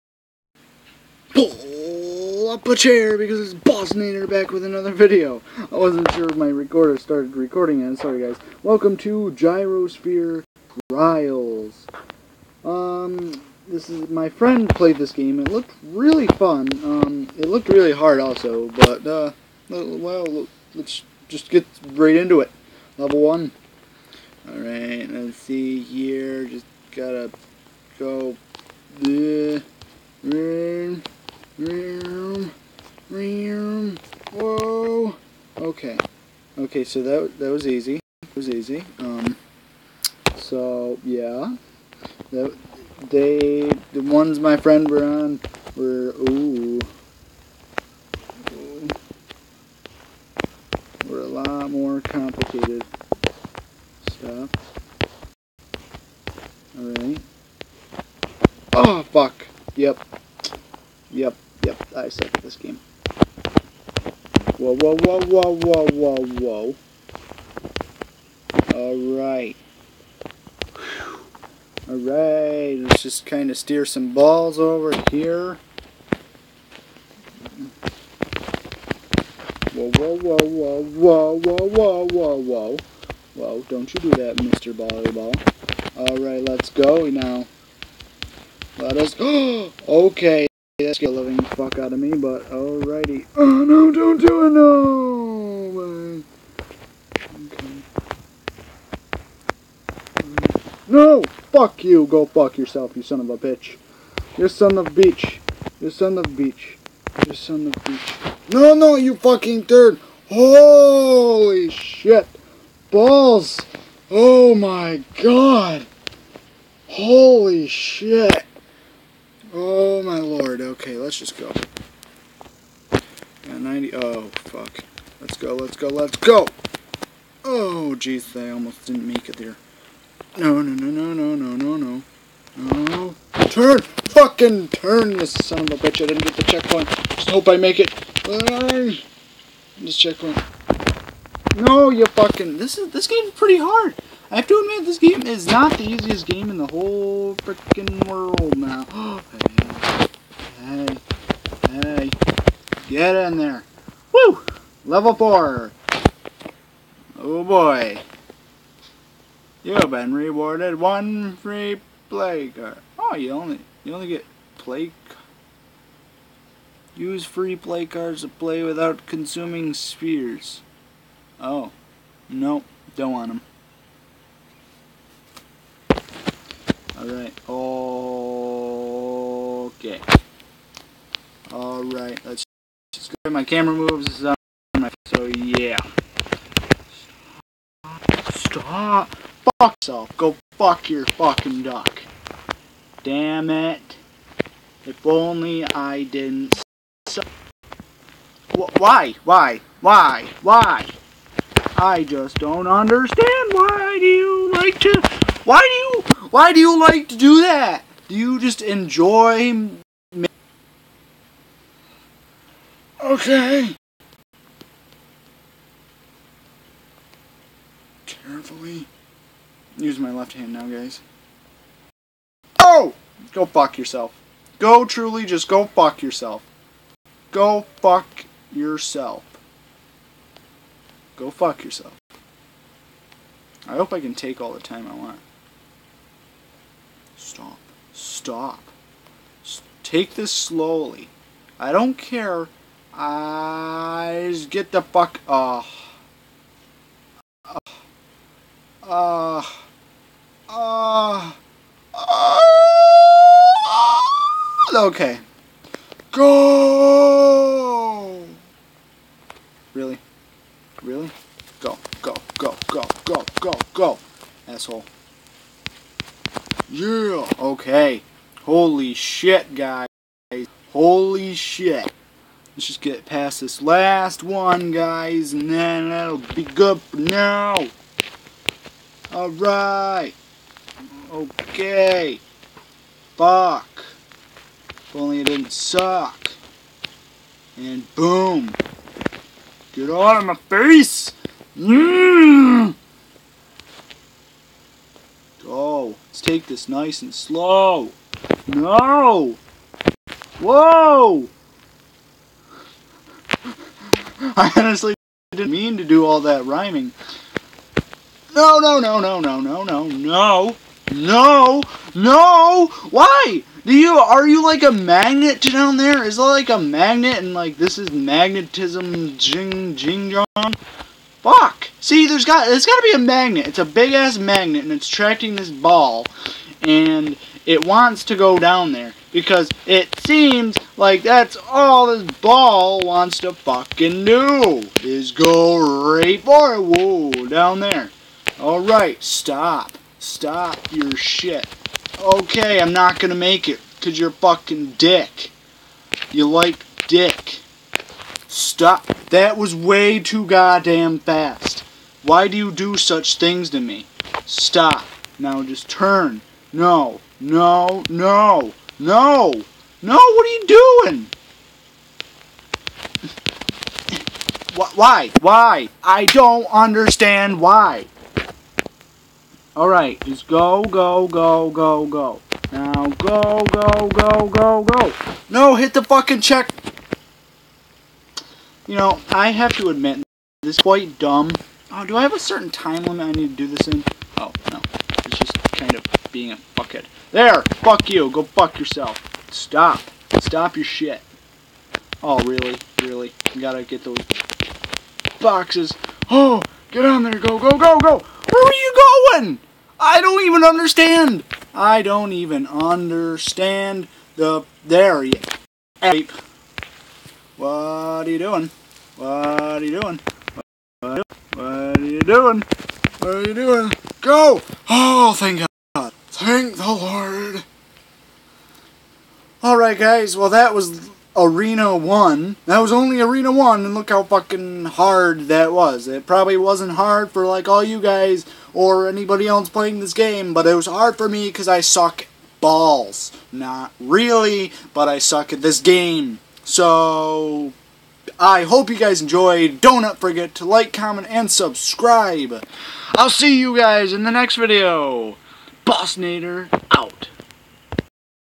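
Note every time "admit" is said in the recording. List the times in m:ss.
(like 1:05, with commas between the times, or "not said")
2:24, 6:19.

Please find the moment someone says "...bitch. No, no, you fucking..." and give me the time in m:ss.
1:47.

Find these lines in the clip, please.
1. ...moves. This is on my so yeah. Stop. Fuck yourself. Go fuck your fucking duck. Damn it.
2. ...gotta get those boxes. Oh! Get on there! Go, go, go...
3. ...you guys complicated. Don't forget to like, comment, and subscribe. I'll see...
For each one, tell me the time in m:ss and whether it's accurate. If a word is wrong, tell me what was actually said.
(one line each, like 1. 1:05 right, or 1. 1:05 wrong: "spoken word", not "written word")
1. 3:03 right
2. 6:33 right
3. 7:18 wrong: "enjoyed", not "complicated".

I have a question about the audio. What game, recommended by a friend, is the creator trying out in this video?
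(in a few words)
Gyrosphere Trials.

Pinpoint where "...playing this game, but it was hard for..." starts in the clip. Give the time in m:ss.
7:09.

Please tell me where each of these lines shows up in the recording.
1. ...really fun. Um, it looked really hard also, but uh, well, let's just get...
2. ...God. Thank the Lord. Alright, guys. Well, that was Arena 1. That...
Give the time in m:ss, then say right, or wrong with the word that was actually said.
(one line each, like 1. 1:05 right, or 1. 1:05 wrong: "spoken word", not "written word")
1. 0:15 right
2. 6:55 right.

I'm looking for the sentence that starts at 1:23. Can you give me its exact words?
Whoa, don't you do that, Mr.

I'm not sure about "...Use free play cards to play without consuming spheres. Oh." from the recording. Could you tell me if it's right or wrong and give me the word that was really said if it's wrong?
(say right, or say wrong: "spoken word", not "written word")
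right.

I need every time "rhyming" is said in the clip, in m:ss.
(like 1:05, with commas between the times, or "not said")
5:06.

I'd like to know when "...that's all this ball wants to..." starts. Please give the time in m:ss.
5:31.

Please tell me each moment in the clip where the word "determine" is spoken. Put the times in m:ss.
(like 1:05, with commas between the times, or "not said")
not said.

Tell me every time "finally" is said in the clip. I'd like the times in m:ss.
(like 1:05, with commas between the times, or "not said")
not said.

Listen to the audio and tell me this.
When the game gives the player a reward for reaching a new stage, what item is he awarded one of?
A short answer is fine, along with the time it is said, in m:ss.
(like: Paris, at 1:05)
free play card, at 2:41.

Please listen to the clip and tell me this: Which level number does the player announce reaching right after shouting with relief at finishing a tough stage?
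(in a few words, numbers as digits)
4.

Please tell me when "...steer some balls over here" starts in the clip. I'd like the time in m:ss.
1:13.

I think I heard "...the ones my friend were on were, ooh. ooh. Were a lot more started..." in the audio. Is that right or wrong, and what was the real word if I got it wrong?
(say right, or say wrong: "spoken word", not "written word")
wrong: "complicated", not "started".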